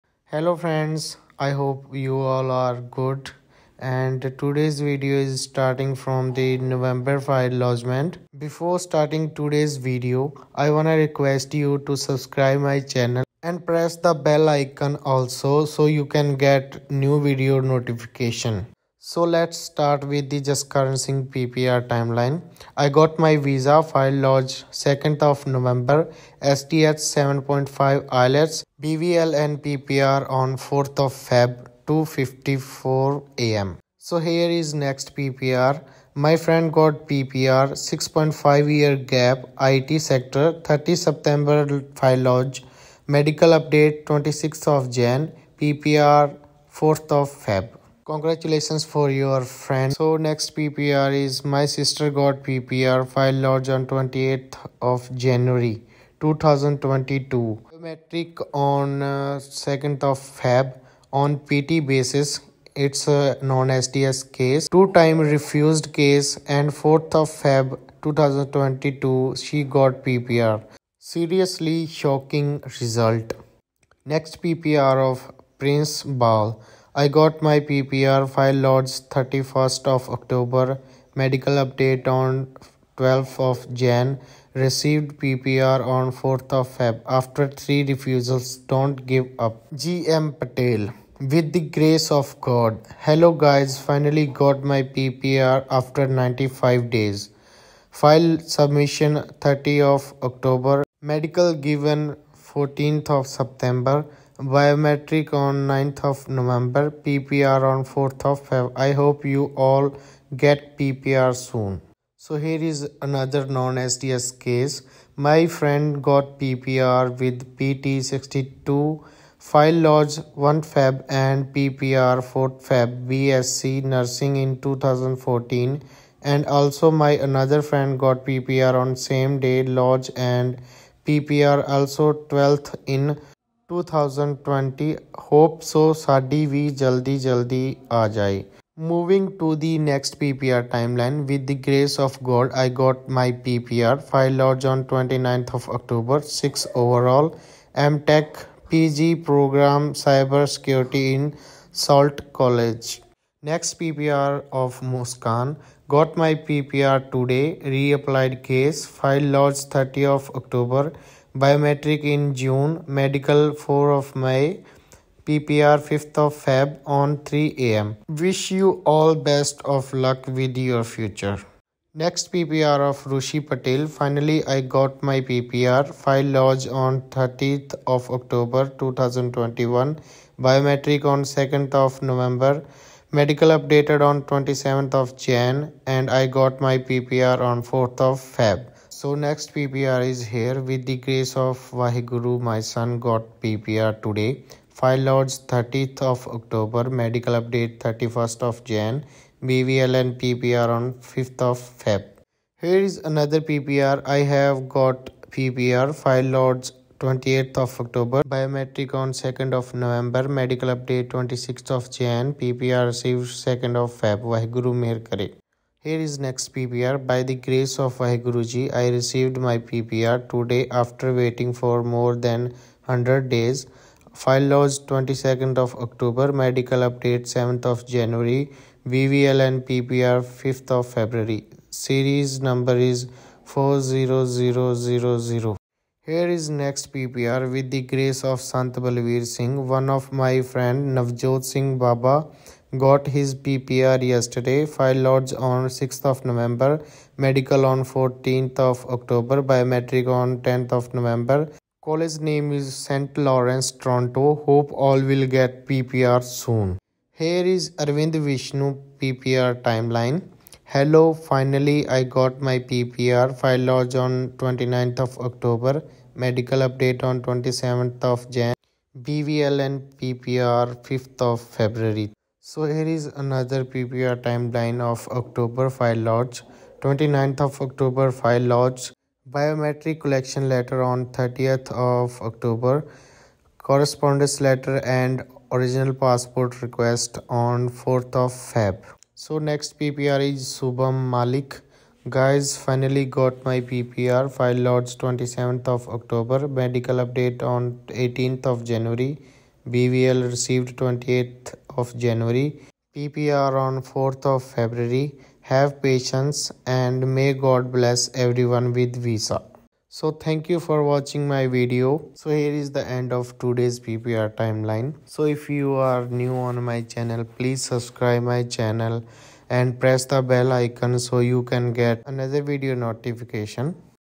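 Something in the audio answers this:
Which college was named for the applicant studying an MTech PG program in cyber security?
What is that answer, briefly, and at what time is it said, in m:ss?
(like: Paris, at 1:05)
Sault College, at 2:31.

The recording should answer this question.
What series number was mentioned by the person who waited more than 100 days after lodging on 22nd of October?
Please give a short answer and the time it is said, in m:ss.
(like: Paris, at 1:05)
40000, at 3:53.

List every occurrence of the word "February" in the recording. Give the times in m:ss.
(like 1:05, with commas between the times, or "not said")
3:50, 4:31, 5:04.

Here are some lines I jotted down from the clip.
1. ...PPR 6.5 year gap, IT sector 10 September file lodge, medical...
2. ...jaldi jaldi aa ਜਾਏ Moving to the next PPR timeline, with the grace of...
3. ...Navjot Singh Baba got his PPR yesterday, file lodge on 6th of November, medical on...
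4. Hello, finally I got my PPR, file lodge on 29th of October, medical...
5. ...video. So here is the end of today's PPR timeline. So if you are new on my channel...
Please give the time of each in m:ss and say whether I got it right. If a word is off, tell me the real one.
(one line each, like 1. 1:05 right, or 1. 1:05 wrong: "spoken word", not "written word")
1. 0:37 wrong: "30", not "10"
2. 2:16 right
3. 4:00 right
4. 4:20 right
5. 5:11 right.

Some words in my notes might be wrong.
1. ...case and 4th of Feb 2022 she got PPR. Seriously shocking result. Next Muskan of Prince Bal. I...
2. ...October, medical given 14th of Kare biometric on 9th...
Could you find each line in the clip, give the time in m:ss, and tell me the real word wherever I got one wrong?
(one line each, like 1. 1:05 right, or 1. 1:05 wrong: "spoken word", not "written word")
1. 1:05 wrong: "PPR", not "Muskan"
2. 1:40 wrong: "September", not "Kare".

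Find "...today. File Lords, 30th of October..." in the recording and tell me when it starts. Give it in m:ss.
3:14.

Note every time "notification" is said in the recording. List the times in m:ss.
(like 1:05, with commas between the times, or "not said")
0:17, 5:22.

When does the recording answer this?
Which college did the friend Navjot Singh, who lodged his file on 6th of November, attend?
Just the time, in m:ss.
4:12.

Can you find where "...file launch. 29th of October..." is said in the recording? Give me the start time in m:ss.
4:35.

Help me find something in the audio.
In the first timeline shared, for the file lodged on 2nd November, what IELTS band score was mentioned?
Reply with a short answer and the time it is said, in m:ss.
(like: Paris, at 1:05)
7.5, at 0:27.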